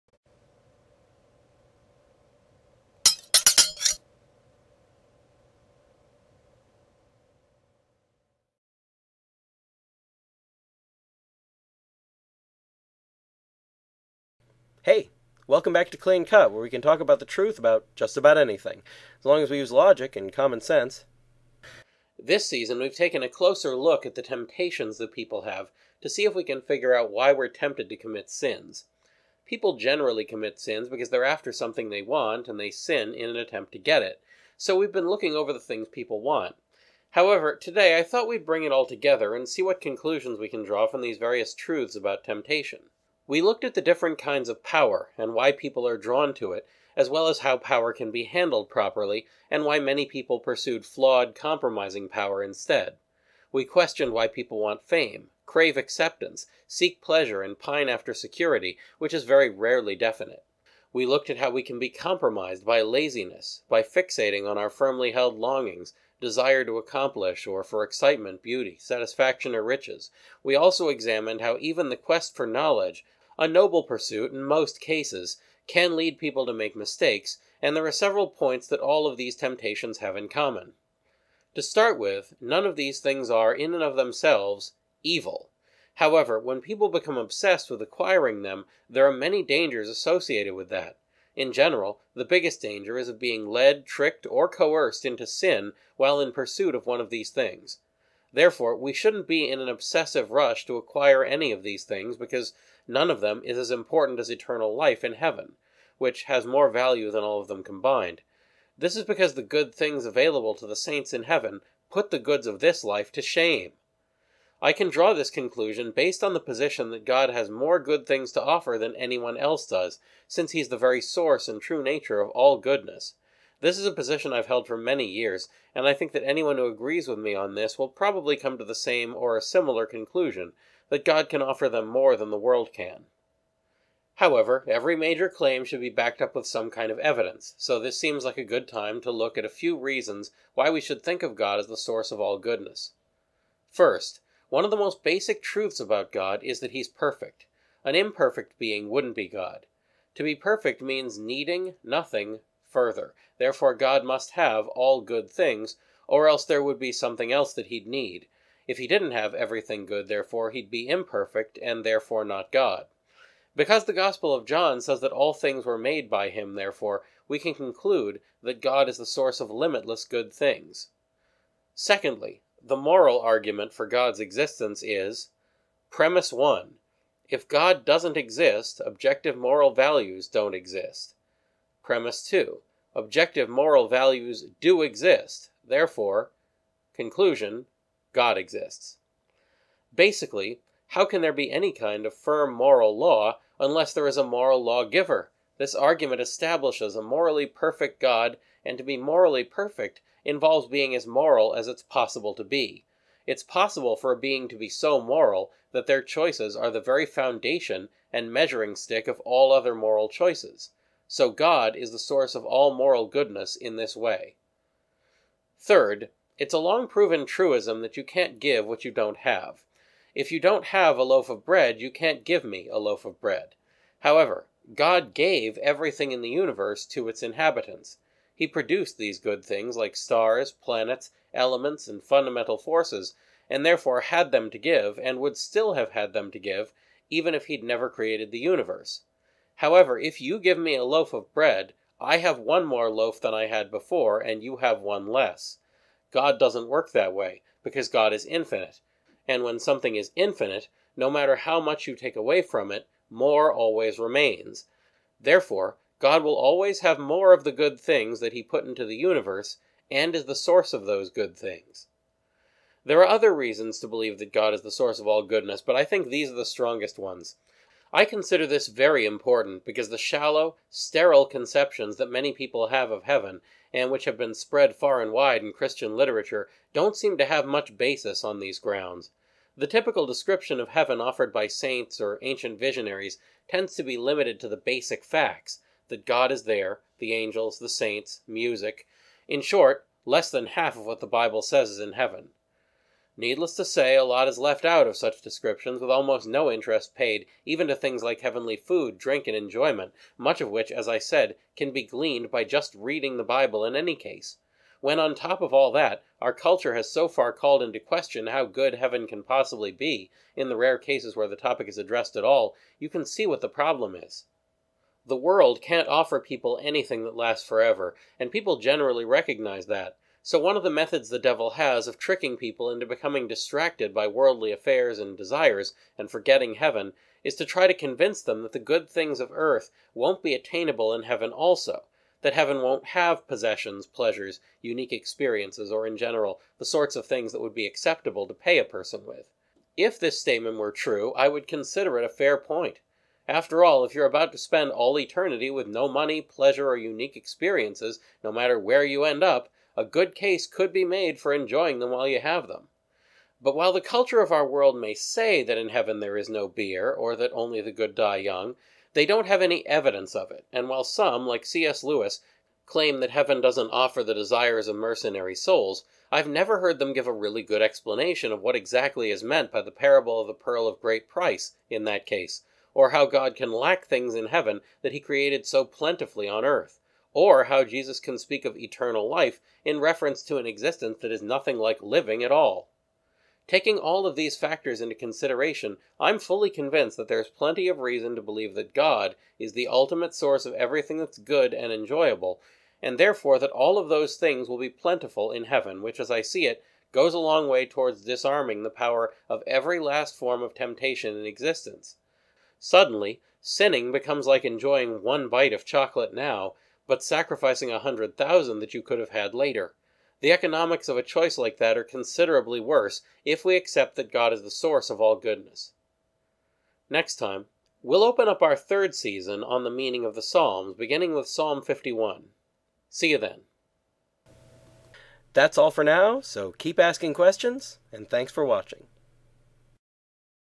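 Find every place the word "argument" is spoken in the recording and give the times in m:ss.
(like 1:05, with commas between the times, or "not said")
2:53, 3:15.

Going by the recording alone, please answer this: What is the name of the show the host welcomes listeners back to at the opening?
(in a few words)
Clean Cut.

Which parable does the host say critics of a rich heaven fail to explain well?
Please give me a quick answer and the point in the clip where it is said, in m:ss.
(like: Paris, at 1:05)
The pearl of great price, at 6:10.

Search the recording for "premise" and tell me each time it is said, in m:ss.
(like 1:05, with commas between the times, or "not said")
2:55, 3:01.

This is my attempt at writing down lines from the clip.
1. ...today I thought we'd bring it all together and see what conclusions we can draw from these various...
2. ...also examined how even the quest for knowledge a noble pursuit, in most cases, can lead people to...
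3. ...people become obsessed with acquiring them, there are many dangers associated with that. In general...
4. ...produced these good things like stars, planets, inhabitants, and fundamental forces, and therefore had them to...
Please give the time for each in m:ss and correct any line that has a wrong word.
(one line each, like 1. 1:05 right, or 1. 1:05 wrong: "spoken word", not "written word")
1. 0:37 right
2. 1:10 right
3. 1:26 right
4. 3:48 wrong: "elements", not "inhabitants".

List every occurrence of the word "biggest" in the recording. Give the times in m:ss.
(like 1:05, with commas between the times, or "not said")
1:32.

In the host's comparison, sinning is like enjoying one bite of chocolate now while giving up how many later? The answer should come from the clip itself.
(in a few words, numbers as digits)
100,000.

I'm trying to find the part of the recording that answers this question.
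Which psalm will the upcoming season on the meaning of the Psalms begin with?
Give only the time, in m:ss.
7:01.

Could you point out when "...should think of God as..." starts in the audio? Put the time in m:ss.
2:20.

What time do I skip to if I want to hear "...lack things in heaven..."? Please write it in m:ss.
6:13.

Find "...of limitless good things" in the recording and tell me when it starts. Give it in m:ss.
2:49.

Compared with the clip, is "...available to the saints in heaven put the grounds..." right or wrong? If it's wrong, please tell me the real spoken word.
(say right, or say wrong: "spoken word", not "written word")
wrong: "goods", not "grounds".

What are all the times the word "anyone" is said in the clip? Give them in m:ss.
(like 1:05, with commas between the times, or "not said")
1:58, 2:06.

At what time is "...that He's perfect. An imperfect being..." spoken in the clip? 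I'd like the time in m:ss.
2:26.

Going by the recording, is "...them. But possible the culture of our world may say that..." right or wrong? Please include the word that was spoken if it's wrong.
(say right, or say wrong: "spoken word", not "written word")
wrong: "while", not "possible".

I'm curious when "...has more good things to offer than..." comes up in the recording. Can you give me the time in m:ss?
1:57.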